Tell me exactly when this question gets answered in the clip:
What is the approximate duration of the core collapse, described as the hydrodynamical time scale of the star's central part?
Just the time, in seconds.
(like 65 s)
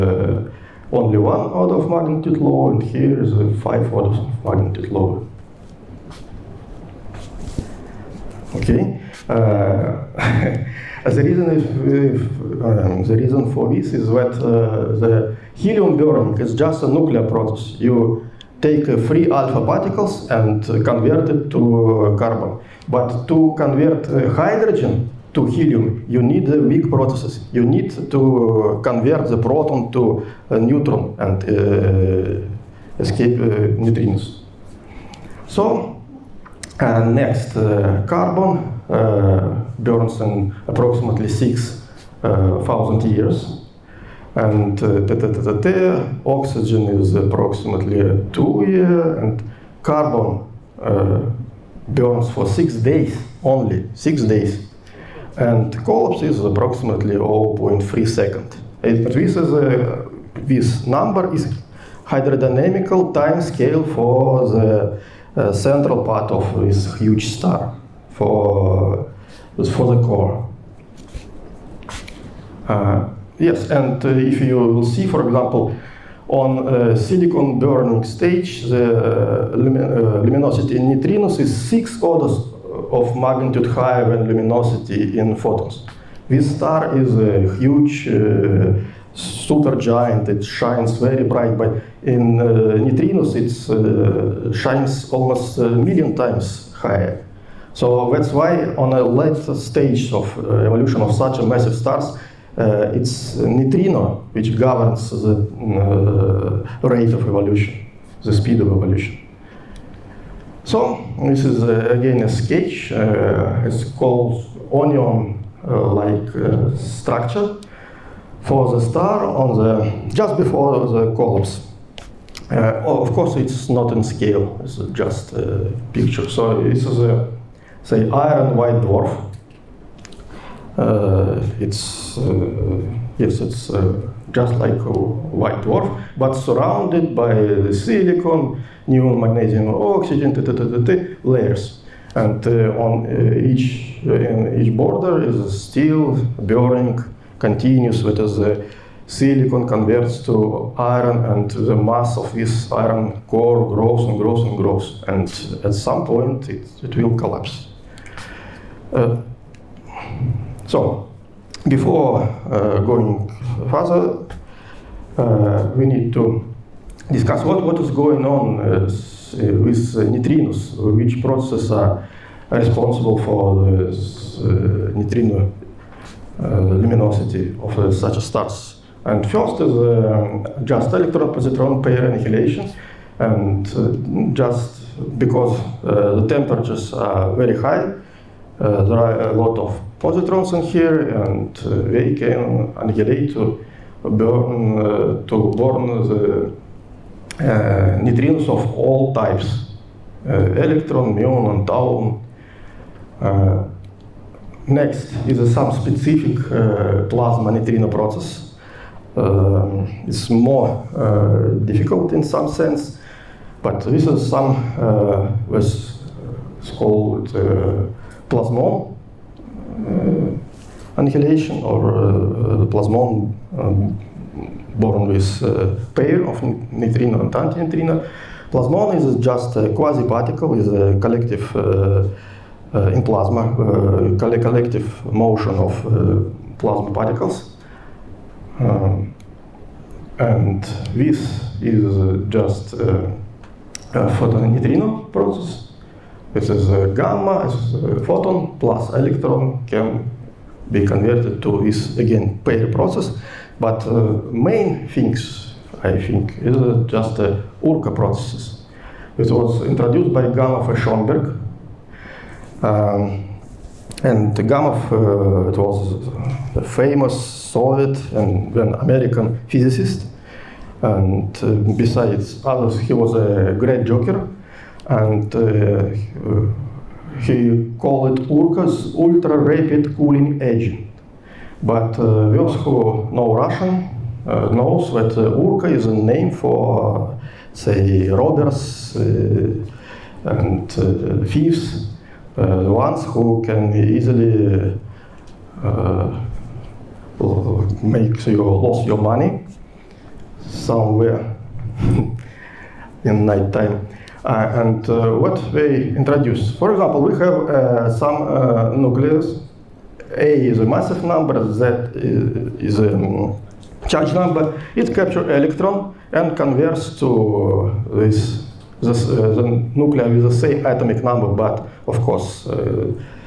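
57 s.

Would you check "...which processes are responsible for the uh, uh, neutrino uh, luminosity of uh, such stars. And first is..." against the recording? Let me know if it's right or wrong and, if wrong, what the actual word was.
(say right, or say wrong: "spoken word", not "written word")
right.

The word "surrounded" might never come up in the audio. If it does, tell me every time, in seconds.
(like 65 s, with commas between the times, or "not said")
136 s.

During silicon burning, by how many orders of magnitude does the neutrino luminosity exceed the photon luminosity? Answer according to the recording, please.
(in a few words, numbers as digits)
6.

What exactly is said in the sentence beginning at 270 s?
And uh, besides others, he was a great joker.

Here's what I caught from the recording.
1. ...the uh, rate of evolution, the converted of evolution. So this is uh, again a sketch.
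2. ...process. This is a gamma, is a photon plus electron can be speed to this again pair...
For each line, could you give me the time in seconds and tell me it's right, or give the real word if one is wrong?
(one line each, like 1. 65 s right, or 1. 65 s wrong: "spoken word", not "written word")
1. 105 s wrong: "speed", not "converted"
2. 245 s wrong: "converted", not "speed".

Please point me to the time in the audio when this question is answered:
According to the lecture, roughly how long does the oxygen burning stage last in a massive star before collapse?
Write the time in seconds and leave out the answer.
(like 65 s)
48 s.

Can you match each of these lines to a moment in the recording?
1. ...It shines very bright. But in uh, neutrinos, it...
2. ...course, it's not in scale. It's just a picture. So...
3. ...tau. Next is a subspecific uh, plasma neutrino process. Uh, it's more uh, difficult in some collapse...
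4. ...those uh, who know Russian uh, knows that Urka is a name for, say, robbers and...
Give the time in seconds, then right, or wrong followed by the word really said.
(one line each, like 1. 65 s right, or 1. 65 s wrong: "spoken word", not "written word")
1. 90 s right
2. 123 s right
3. 201 s wrong: "sense", not "collapse"
4. 281 s right.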